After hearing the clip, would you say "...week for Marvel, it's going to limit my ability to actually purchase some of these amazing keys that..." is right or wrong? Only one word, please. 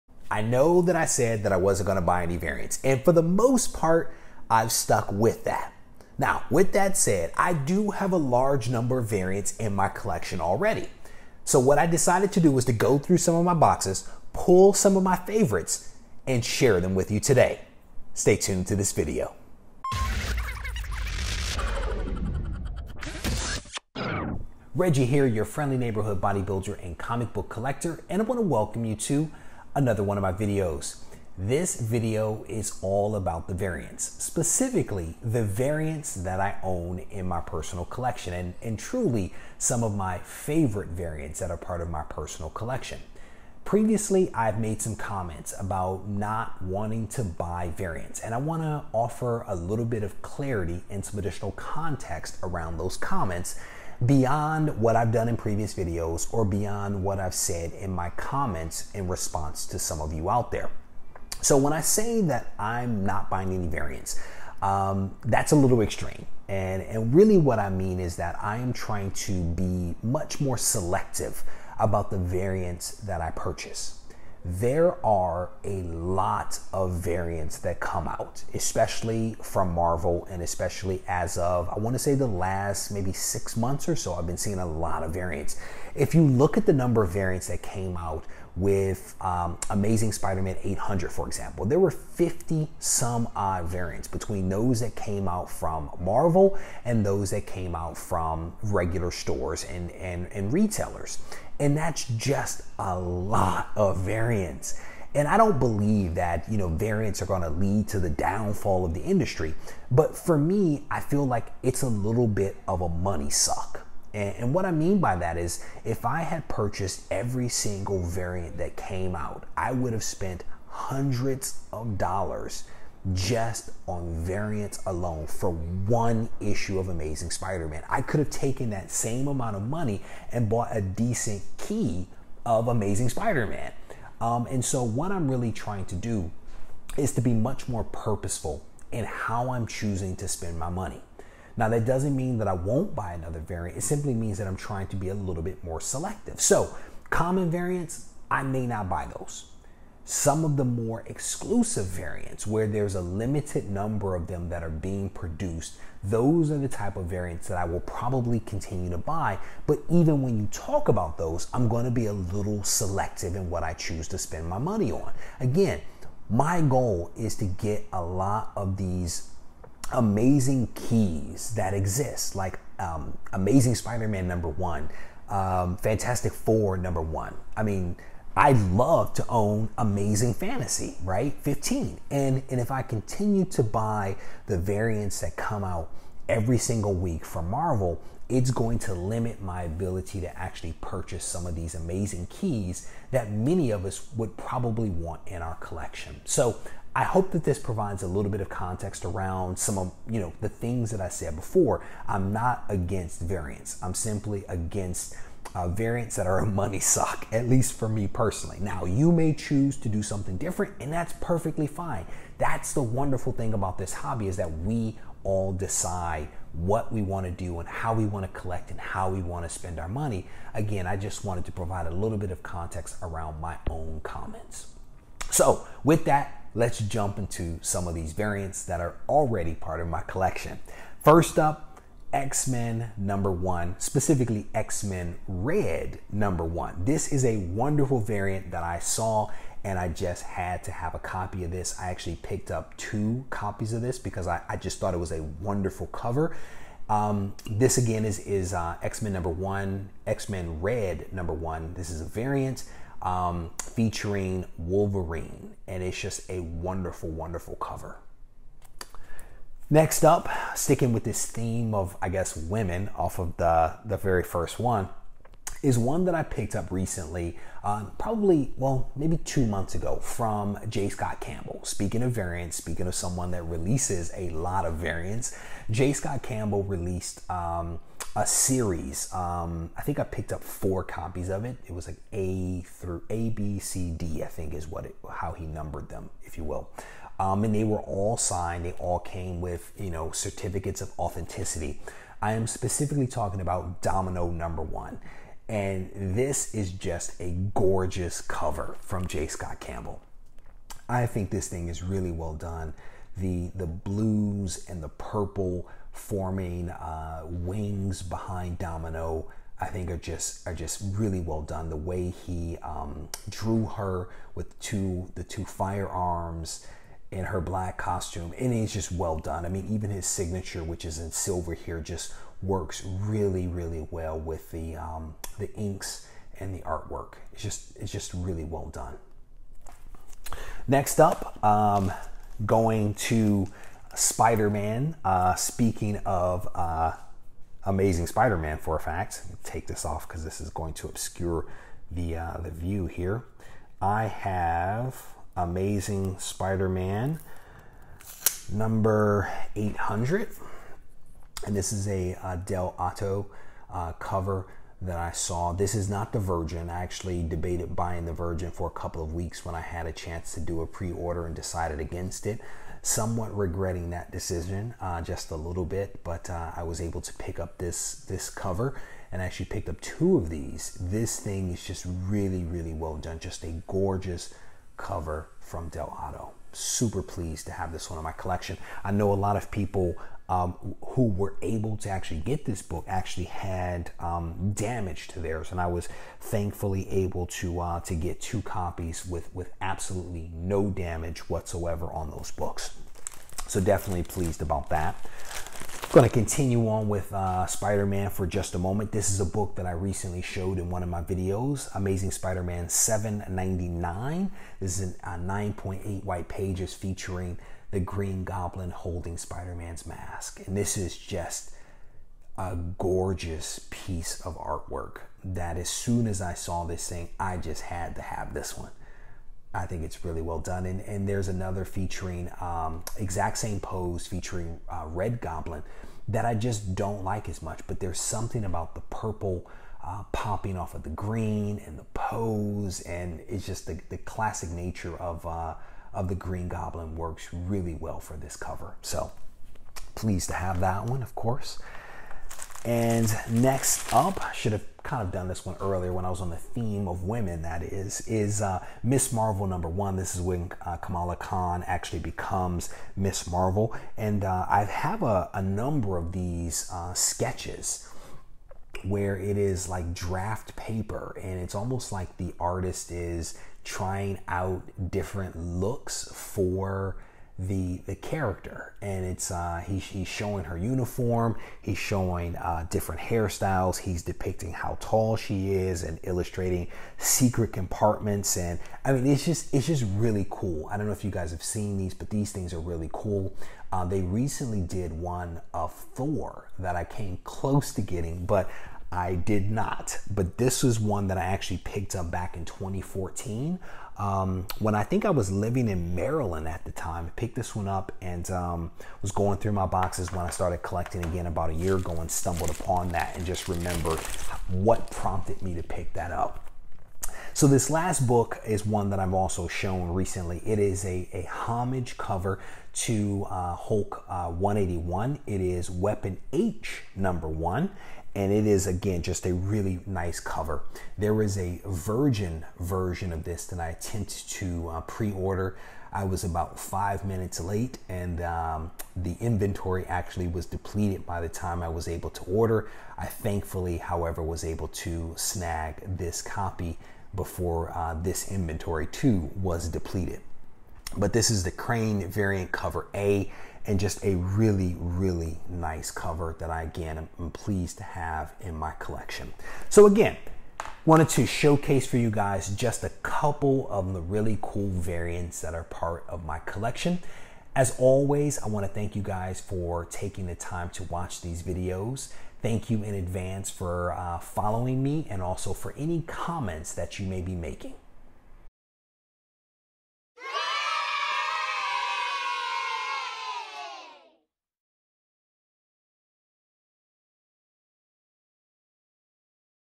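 right.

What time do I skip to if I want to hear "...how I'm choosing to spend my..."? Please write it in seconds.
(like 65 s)
139 s.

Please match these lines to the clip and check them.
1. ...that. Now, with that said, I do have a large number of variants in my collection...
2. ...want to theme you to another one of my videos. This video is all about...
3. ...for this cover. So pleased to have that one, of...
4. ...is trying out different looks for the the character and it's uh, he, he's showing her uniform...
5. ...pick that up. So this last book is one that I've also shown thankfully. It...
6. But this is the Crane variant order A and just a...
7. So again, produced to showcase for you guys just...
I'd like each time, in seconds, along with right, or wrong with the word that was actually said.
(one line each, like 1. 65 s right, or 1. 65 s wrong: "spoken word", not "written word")
1. 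5 s right
2. 28 s wrong: "welcome", not "theme"
3. 437 s right
4. 462 s right
5. 505 s wrong: "recently", not "thankfully"
6. 540 s wrong: "cover", not "order"
7. 549 s wrong: "wanted", not "produced".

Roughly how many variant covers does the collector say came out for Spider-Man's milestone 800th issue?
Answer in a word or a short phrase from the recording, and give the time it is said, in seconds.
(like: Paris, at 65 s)
50 some odd, at 91 s.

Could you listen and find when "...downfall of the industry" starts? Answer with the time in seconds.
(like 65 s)
108 s.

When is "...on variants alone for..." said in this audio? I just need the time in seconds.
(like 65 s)
123 s.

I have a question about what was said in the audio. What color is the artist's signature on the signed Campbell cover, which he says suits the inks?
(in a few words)
Silver.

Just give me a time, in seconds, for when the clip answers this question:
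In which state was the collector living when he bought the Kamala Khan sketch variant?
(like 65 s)
495 s.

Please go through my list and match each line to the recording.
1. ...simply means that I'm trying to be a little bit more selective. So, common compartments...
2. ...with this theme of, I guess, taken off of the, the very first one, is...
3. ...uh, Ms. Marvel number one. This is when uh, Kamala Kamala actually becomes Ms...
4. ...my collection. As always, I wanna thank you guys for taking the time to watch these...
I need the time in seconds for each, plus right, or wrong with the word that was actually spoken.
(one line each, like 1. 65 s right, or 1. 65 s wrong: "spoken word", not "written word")
1. 143 s wrong: "variants", not "compartments"
2. 260 s wrong: "women", not "taken"
3. 448 s wrong: "Khan", not "Kamala"
4. 556 s right.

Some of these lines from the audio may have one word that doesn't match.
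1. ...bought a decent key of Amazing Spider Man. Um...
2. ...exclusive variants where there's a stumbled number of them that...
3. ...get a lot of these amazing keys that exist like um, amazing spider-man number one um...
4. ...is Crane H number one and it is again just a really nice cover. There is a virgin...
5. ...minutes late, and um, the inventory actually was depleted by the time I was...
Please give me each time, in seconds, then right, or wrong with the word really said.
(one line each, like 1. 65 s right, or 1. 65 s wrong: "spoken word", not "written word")
1. 130 s right
2. 151 s wrong: "limited", not "stumbled"
3. 167 s right
4. 515 s wrong: "Weapon", not "Crane"
5. 527 s right.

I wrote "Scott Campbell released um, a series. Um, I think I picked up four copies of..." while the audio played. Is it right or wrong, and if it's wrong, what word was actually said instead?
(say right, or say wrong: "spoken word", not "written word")
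right.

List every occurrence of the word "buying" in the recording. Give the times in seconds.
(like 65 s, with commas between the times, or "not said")
63 s, 357 s.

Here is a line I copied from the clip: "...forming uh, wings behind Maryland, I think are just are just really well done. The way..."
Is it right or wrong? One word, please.
wrong.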